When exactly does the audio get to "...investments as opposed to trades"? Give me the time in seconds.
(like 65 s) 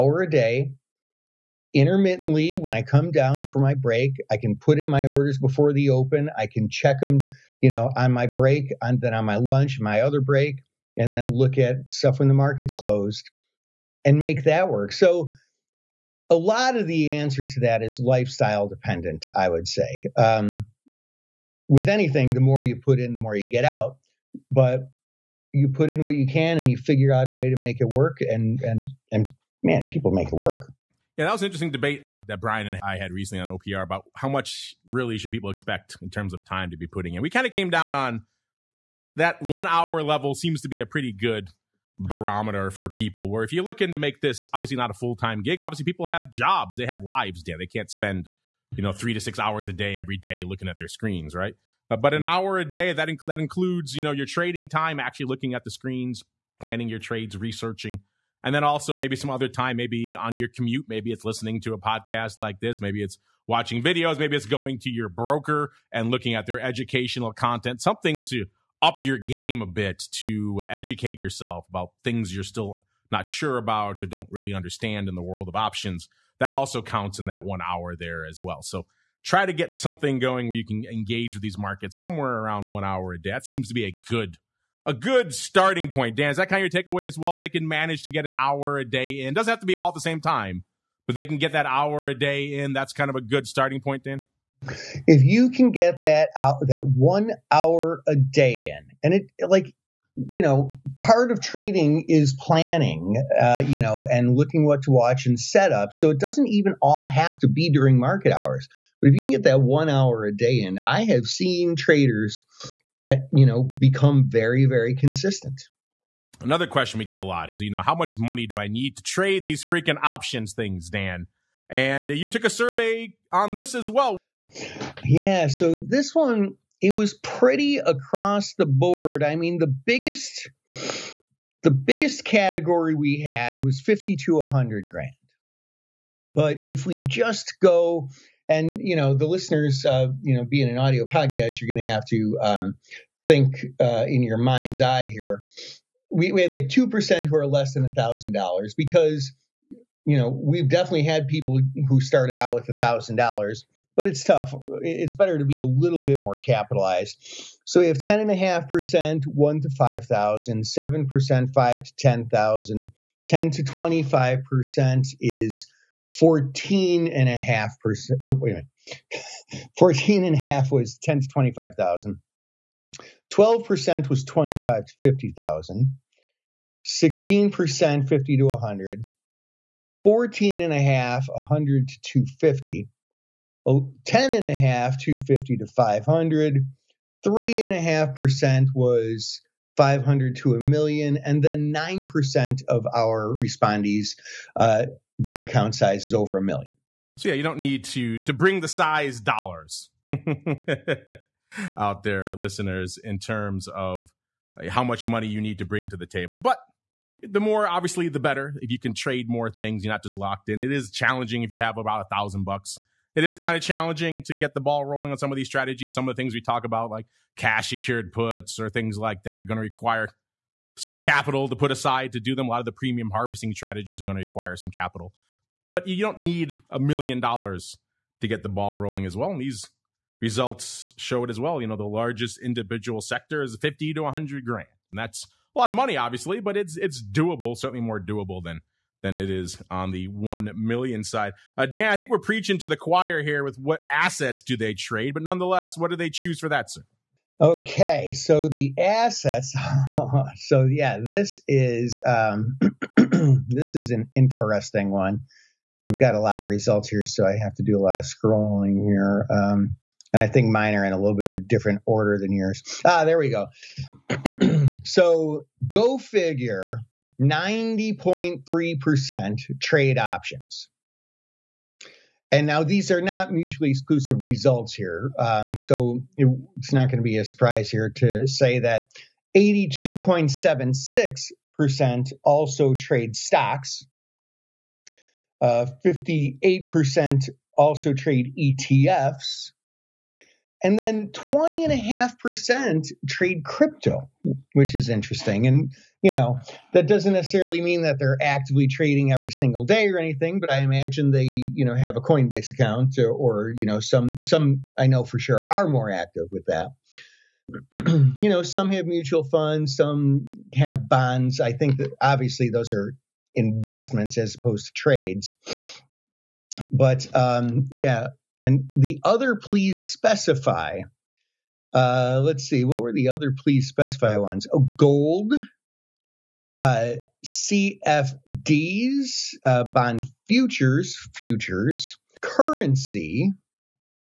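313 s.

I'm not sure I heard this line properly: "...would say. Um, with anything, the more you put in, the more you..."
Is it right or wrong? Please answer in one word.
right.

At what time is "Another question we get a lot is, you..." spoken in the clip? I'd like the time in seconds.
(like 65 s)
116 s.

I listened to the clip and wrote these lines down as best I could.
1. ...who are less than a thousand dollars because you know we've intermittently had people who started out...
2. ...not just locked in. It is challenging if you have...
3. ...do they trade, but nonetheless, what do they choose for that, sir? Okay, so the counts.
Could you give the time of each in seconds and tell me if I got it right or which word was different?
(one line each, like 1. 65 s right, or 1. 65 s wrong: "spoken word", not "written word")
1. 147 s wrong: "definitely", not "intermittently"
2. 209 s right
3. 244 s wrong: "assets", not "counts".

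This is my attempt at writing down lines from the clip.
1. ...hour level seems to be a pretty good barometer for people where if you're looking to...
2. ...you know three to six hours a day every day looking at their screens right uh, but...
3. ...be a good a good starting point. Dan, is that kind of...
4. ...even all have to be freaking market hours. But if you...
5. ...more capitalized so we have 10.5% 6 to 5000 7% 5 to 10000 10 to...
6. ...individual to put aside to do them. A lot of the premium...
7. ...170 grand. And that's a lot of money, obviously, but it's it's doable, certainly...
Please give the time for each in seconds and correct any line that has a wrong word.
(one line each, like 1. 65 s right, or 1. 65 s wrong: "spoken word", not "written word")
1. 39 s right
2. 48 s right
3. 83 s right
4. 106 s wrong: "during", not "freaking"
5. 156 s wrong: "1", not "6"
6. 220 s wrong: "capital", not "individual"
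7. 234 s wrong: "100", not "170".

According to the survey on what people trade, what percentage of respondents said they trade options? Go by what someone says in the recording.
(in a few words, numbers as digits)
90.3%.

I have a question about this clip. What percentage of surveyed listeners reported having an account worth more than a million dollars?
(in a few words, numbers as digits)
9%.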